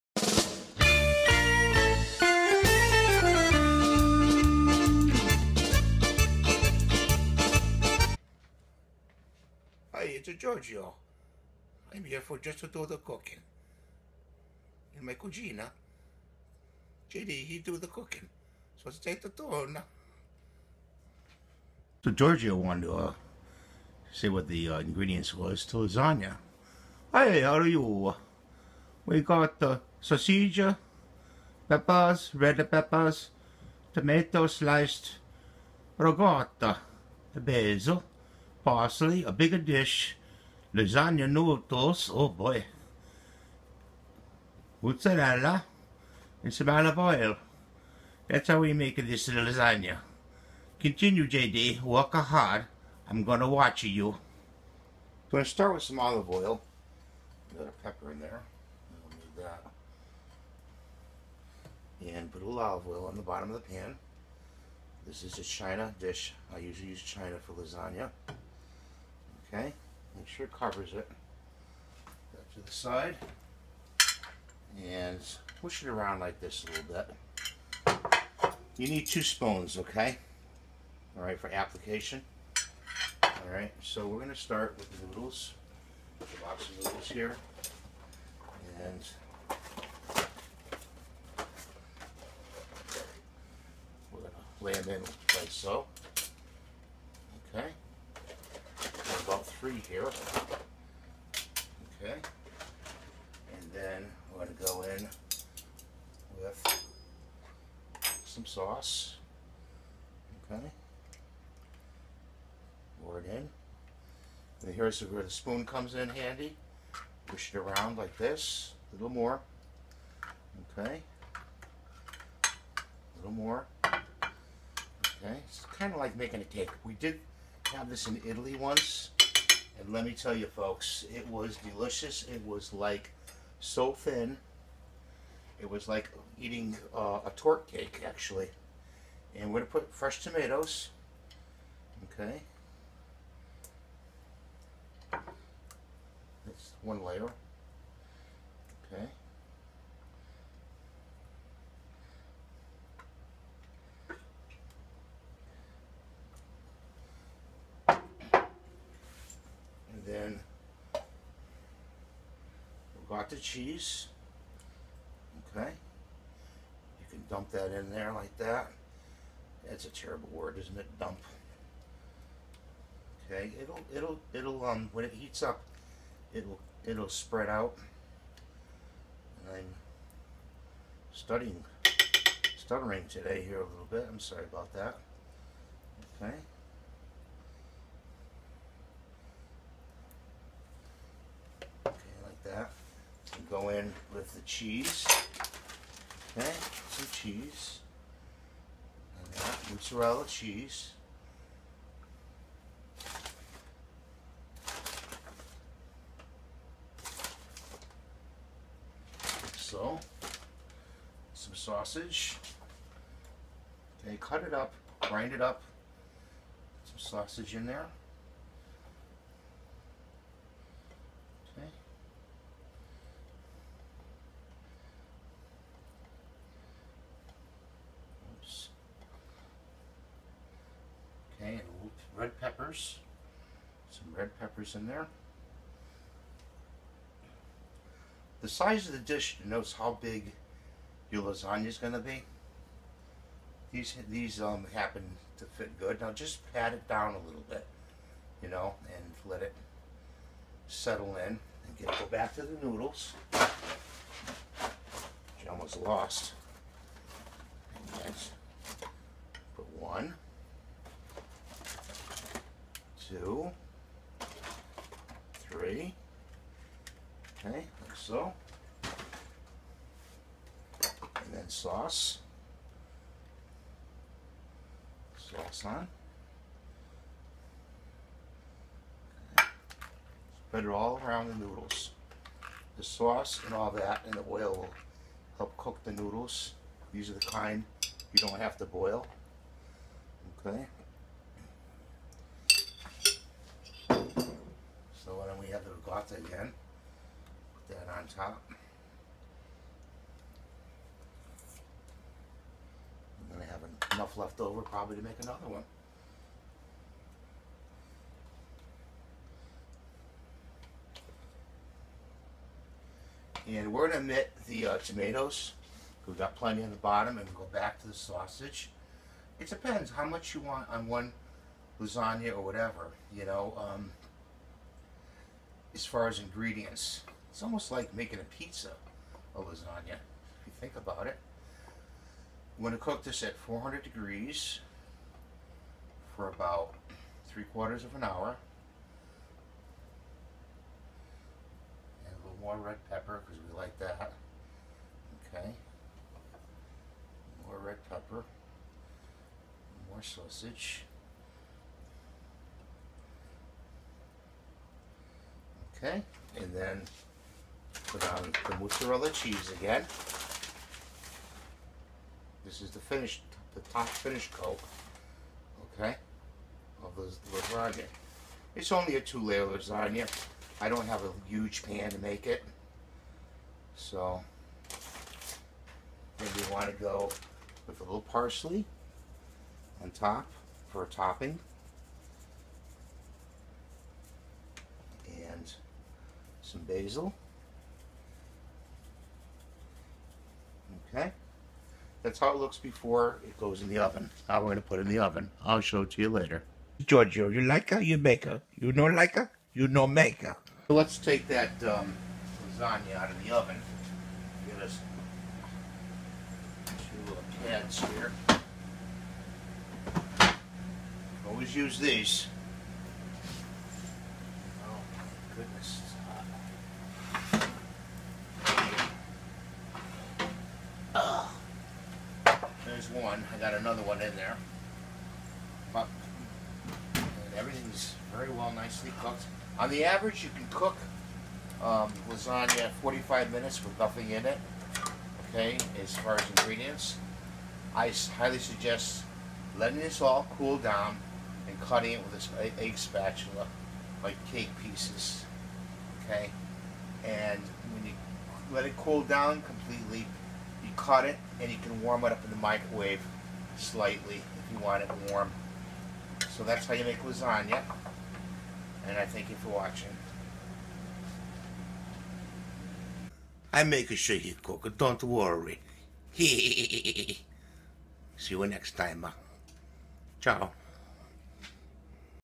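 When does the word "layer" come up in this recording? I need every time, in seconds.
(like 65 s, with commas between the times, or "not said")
147 s, 369 s.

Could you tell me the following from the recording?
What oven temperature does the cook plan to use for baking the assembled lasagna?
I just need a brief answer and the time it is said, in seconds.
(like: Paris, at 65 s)
400 degrees, at 333 s.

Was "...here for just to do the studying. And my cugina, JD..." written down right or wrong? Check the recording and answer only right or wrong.
wrong.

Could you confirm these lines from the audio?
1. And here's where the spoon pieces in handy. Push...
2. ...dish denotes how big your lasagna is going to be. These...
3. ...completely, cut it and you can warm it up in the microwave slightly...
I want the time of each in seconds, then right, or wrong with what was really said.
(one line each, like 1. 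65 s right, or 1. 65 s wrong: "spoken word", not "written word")
1. 114 s wrong: "comes", not "pieces"
2. 238 s right
3. 449 s right.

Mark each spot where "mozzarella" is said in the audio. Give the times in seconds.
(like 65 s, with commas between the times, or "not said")
44 s, 199 s, 358 s.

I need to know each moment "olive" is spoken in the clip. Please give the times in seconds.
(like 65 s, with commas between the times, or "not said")
46 s, 55 s, 62 s.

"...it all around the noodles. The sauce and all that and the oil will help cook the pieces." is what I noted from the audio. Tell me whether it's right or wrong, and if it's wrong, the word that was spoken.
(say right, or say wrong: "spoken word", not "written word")
wrong: "noodles", not "pieces".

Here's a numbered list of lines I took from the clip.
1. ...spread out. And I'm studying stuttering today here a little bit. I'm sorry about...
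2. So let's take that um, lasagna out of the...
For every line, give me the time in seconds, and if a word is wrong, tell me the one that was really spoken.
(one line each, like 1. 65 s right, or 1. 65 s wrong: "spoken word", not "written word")
1. 177 s right
2. 400 s right.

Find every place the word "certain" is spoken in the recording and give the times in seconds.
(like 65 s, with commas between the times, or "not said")
not said.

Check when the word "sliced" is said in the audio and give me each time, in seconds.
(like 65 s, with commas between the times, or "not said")
34 s.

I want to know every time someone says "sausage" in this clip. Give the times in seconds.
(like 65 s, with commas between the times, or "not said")
30 s, 211 s, 216 s, 317 s, 350 s.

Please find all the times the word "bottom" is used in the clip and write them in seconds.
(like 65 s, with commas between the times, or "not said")
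63 s, 316 s.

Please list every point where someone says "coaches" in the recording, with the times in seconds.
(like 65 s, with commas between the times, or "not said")
not said.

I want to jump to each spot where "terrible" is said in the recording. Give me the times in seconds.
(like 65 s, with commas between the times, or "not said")
100 s, 169 s.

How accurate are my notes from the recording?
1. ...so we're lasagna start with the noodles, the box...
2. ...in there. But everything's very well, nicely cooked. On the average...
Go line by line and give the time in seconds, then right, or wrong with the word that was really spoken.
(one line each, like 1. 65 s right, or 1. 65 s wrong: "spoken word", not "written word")
1. 83 s wrong: "gonna", not "lasagna"
2. 424 s right.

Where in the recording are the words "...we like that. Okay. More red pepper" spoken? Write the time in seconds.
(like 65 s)
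343 s.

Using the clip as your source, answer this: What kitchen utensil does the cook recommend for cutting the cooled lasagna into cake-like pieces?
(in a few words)
Egg spatula.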